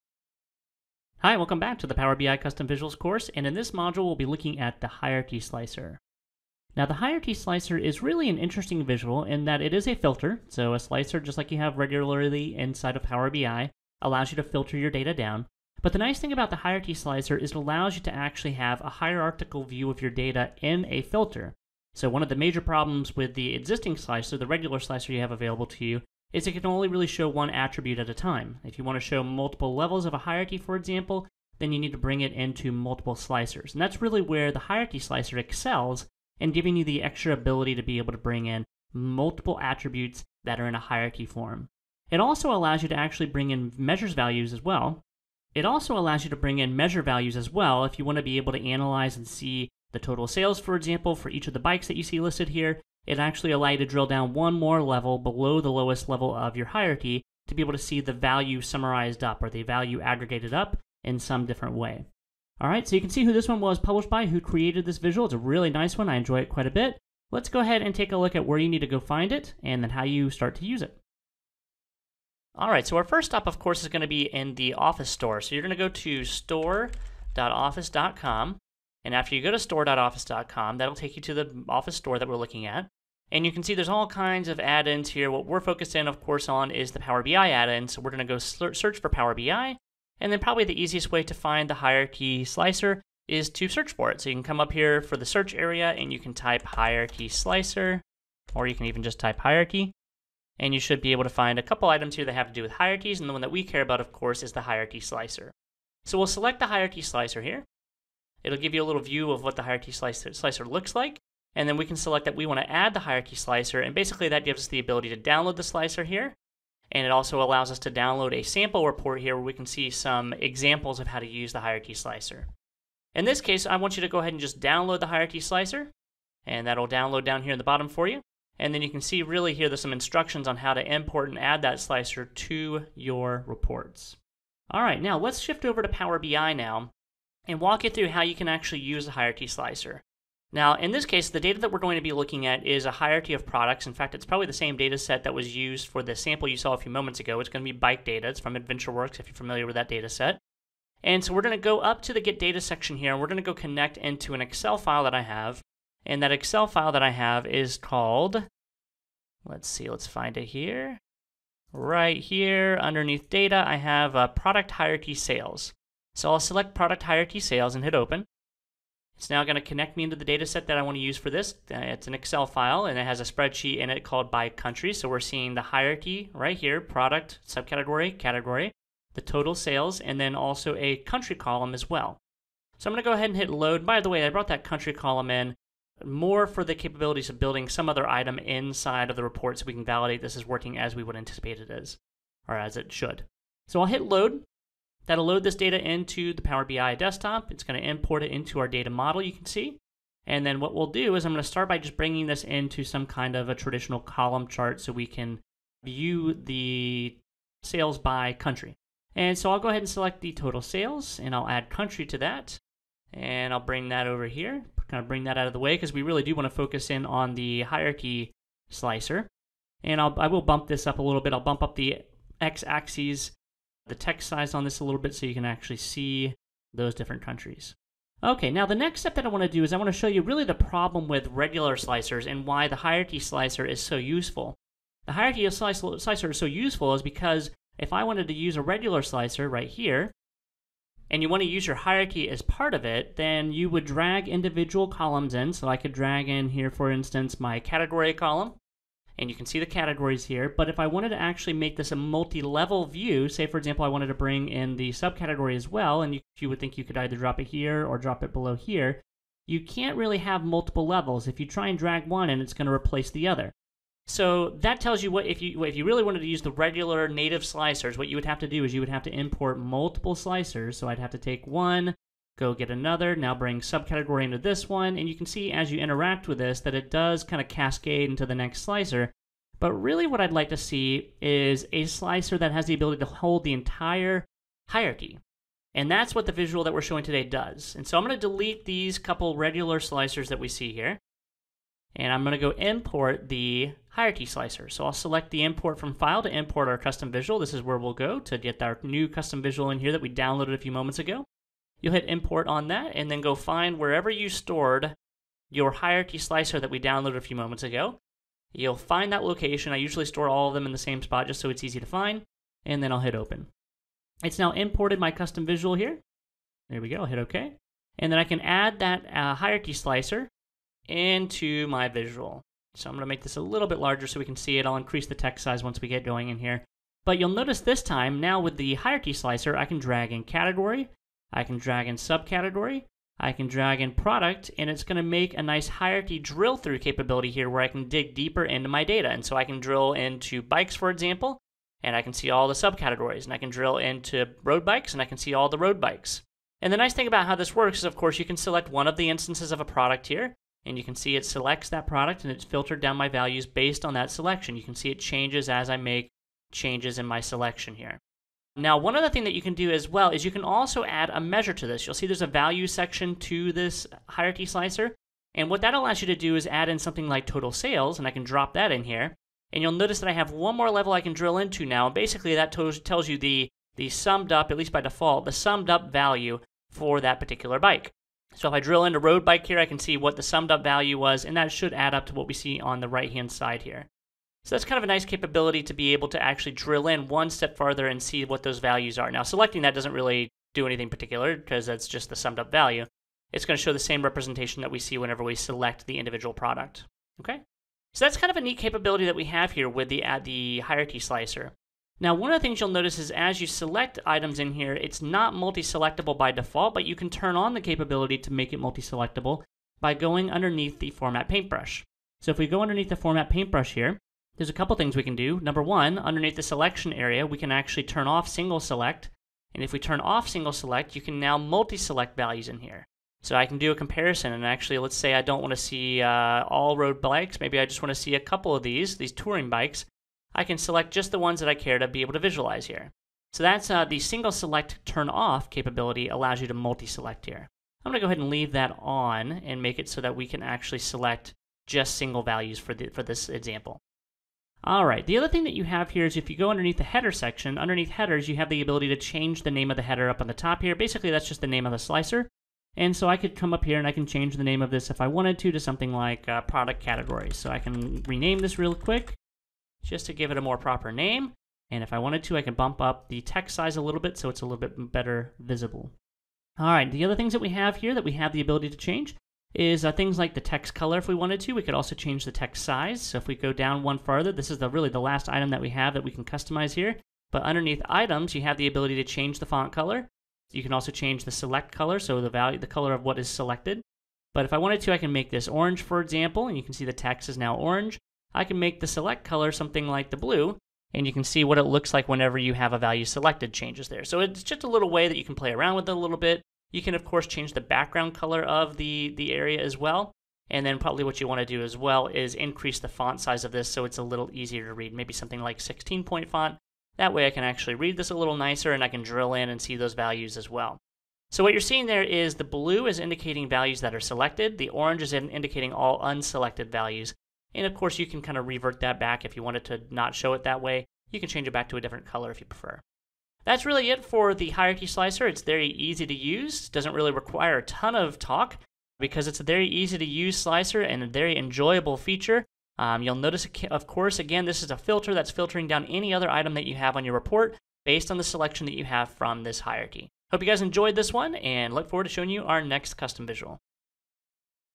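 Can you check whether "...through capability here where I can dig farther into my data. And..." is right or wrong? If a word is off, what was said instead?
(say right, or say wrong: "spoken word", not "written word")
wrong: "deeper", not "farther".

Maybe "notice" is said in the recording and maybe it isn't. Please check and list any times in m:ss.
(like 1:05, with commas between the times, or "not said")
5:27, 6:09, 6:42, 8:53.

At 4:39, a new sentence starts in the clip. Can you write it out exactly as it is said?
But really what I'd like to see is a slicer that has the ability to hold the entire hierarchy.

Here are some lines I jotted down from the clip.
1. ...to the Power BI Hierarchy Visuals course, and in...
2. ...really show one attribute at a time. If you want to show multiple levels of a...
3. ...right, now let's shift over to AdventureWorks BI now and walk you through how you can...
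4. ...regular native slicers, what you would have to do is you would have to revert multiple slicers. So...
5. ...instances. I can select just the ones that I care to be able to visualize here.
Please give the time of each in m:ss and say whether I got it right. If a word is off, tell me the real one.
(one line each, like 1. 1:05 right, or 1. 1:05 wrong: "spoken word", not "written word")
1. 0:01 wrong: "Custom", not "Hierarchy"
2. 0:26 right
3. 2:14 wrong: "Power", not "AdventureWorks"
4. 4:26 wrong: "import", not "revert"
5. 7:09 wrong: "bikes", not "instances".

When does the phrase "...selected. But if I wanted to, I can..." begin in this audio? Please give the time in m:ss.
8:03.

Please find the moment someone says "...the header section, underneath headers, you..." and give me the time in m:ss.
7:26.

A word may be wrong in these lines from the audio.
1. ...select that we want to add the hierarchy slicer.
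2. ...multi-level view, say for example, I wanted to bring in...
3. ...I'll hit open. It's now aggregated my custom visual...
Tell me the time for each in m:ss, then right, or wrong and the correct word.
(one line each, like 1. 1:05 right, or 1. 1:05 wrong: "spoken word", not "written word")
1. 1:51 right
2. 4:11 right
3. 5:12 wrong: "imported", not "aggregated".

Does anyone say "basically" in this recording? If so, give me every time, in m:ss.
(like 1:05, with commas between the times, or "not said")
1:53, 6:11, 7:30.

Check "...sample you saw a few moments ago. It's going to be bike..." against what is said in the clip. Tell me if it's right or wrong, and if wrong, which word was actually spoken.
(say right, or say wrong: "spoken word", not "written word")
right.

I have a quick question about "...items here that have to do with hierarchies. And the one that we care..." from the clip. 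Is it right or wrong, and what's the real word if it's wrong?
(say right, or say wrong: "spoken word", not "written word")
right.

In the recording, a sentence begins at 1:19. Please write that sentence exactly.
And after you go to store.office.com, that'll take you to the Office store that we're looking at.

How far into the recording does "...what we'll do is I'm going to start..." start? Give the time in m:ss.
3:20.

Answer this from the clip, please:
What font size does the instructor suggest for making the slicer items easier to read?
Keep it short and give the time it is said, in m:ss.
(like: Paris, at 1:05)
16 point, at 8:25.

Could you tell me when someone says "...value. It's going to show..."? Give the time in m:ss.
6:32.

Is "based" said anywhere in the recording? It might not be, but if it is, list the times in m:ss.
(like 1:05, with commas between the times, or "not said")
5:53, 8:57.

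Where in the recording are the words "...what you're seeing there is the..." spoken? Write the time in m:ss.
8:31.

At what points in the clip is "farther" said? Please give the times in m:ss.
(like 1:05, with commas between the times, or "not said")
6:27, 7:53.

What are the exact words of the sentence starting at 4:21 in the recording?
If you try and drag one and it's going to replace the other.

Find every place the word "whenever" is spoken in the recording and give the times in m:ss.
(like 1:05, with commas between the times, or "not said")
6:34, 8:12.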